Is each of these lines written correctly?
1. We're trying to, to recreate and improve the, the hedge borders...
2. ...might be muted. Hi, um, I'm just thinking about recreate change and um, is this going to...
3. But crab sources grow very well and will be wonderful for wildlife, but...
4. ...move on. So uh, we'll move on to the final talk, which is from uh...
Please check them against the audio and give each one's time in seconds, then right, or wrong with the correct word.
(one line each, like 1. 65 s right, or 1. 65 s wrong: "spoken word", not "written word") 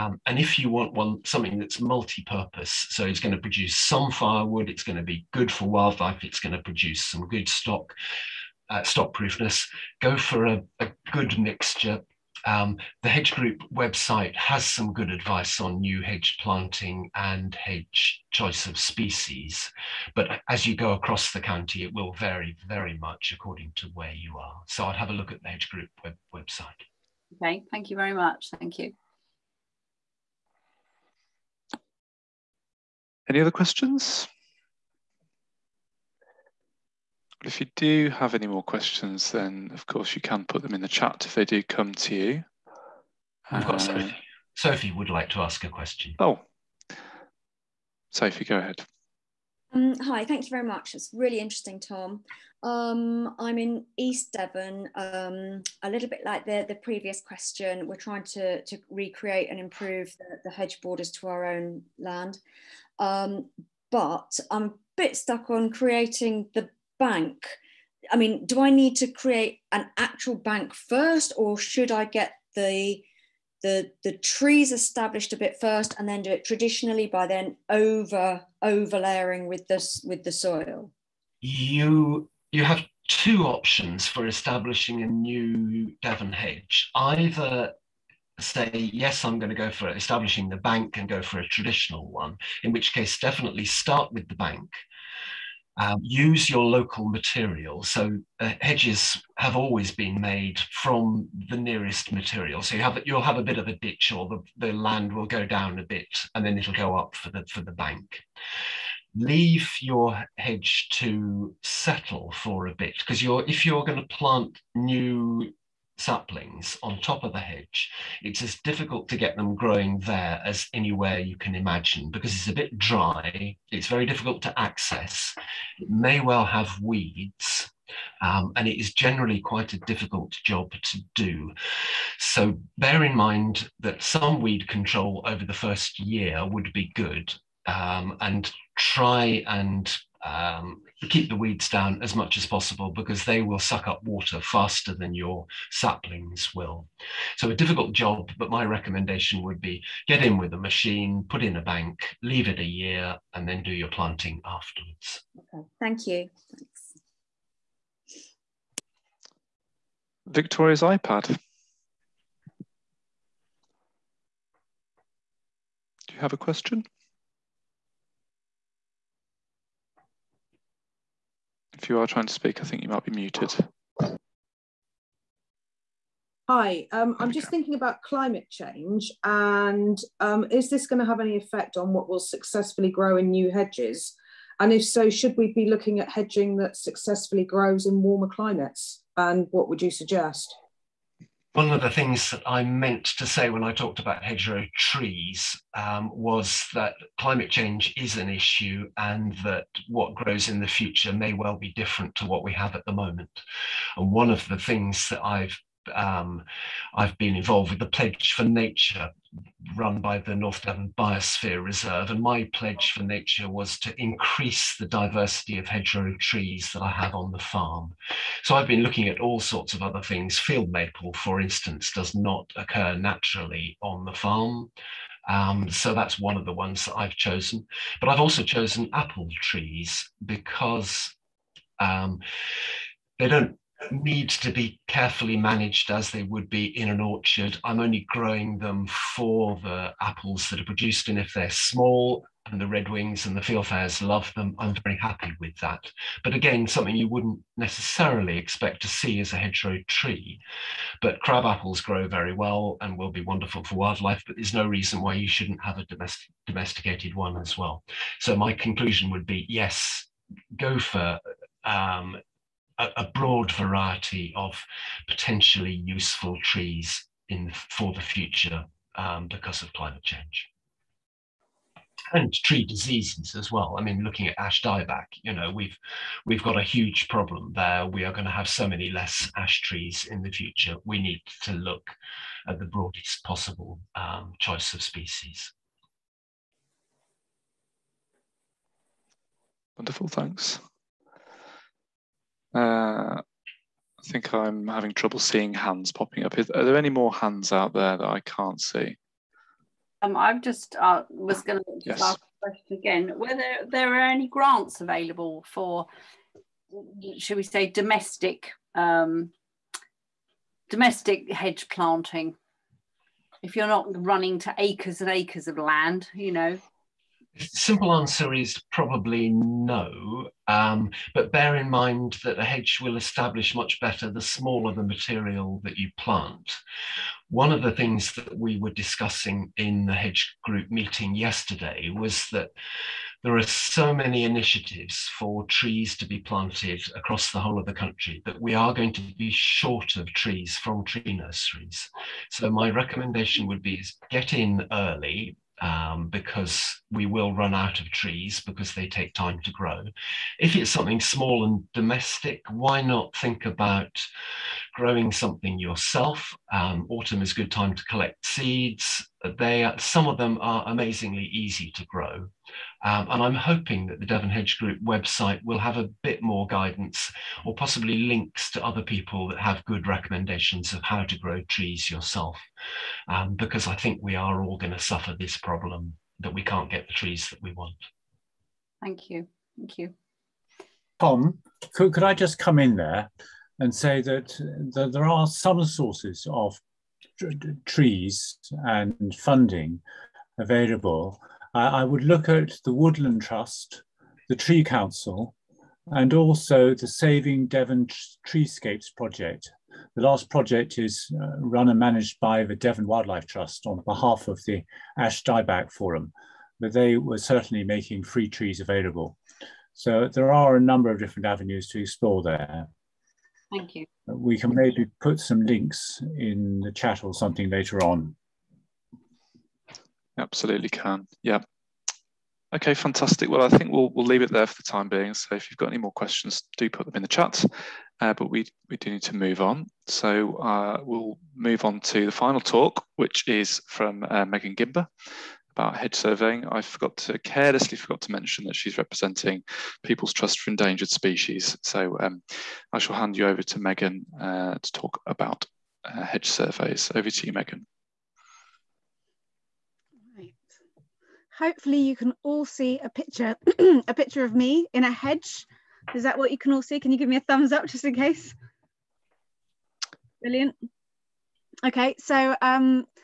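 1. 57 s right
2. 172 s wrong: "climate", not "recreate"
3. 251 s wrong: "apples", not "sources"
4. 429 s right.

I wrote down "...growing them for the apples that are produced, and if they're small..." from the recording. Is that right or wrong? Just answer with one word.
right.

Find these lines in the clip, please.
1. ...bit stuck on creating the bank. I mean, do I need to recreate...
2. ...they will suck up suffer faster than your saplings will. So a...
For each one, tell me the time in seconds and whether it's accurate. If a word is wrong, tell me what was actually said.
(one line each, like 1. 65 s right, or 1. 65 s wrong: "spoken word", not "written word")
1. 64 s wrong: "create", not "recreate"
2. 143 s wrong: "water", not "suffer".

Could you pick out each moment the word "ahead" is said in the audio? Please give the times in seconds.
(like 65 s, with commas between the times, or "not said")
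48 s.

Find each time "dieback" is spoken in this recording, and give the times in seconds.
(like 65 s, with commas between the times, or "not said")
274 s, 405 s.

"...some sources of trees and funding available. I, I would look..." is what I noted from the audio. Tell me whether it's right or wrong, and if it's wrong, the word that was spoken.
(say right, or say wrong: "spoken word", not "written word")
right.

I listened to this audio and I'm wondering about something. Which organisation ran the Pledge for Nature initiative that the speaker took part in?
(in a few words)
North Devon Biosphere Reserve.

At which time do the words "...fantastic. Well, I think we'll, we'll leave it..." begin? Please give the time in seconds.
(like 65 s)
422 s.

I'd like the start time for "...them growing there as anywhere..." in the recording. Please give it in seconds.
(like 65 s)
119 s.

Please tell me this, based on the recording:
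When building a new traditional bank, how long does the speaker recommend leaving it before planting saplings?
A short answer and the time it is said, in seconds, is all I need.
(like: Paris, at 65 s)
A year, at 152 s.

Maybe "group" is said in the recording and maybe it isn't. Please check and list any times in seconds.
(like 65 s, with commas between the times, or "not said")
13 s, 25 s, 330 s, 364 s.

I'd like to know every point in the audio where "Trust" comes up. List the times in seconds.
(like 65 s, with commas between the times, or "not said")
393 s, 403 s, 440 s.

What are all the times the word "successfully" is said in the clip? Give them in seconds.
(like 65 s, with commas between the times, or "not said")
182 s, 186 s.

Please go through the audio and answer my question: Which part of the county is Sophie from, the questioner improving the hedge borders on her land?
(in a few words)
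East Devon.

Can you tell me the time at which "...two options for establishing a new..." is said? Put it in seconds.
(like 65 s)
83 s.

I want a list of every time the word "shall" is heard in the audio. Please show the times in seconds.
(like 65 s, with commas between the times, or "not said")
442 s.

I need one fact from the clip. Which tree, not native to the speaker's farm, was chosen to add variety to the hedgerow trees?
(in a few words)
Field maple.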